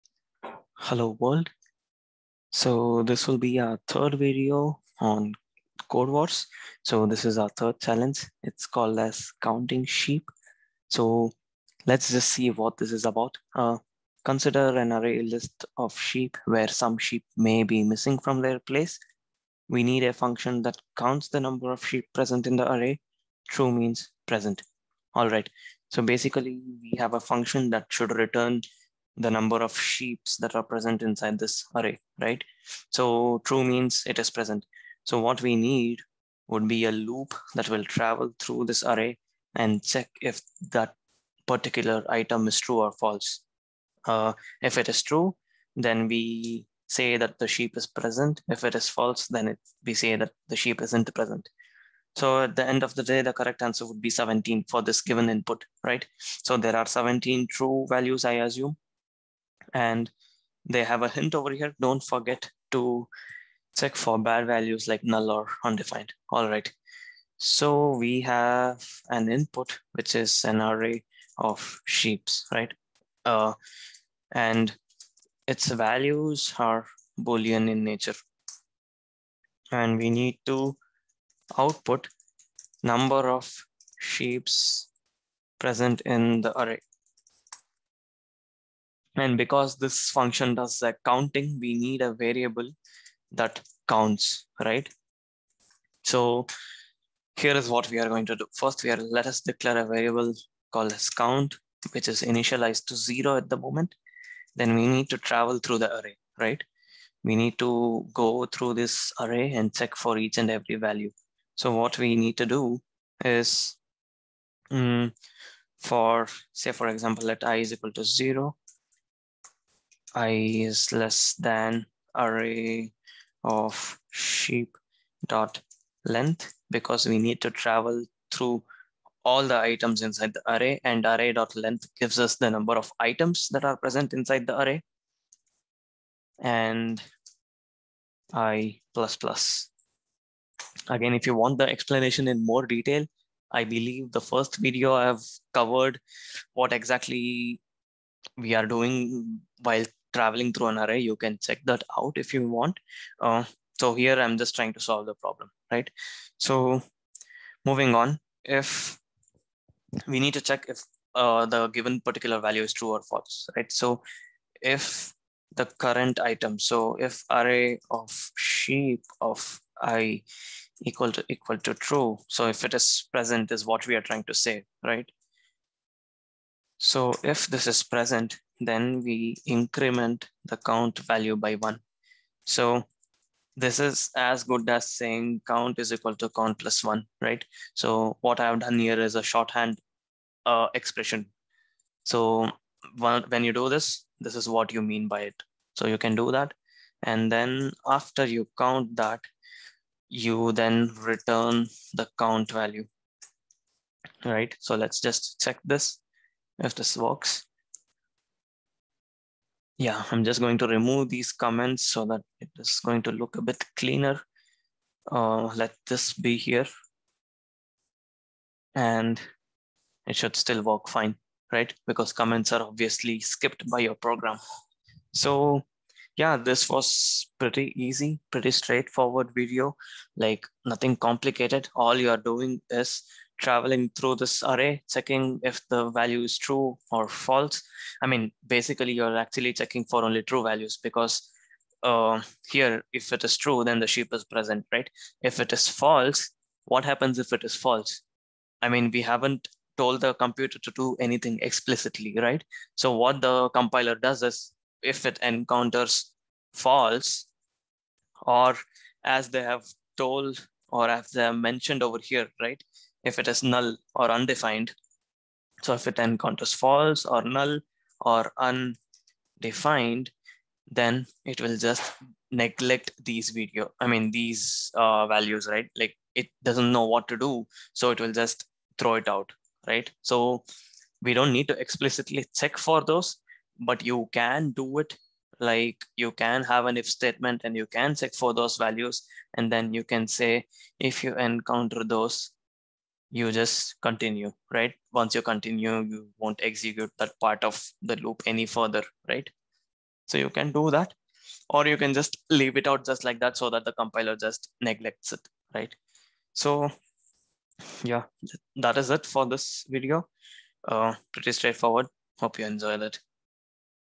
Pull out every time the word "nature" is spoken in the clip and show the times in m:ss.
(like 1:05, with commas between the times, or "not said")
1:17.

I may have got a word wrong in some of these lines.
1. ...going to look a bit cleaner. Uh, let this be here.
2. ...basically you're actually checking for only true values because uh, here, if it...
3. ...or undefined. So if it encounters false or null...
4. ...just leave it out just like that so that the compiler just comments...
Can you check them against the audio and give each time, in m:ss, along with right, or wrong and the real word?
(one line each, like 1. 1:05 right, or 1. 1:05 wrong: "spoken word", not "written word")
1. 3:32 right
2. 3:58 right
3. 4:23 right
4. 5:01 wrong: "neglects", not "comments".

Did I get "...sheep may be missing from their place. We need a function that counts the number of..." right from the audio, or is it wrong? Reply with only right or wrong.
right.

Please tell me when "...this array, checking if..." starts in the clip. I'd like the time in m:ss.
3:54.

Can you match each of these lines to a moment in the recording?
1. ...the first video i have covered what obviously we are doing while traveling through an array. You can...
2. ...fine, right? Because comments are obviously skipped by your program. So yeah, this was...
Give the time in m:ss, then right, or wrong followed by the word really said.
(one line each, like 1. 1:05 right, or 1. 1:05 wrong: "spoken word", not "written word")
1. 2:24 wrong: "exactly", not "obviously"
2. 3:40 right.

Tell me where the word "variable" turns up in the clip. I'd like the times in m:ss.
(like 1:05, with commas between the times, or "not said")
1:32, 1:39.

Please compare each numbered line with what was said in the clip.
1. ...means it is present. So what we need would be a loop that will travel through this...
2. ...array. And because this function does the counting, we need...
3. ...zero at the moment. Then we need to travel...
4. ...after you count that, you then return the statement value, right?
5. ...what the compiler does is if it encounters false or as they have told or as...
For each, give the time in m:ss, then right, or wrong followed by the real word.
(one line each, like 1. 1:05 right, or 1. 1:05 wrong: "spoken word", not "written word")
1. 0:33 right
2. 1:26 right
3. 1:42 right
4. 3:17 wrong: "count", not "statement"
5. 4:12 right.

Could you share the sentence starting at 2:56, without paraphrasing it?
So if this is present, then we increment the count value by one.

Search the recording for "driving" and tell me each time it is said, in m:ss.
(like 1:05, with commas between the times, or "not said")
not said.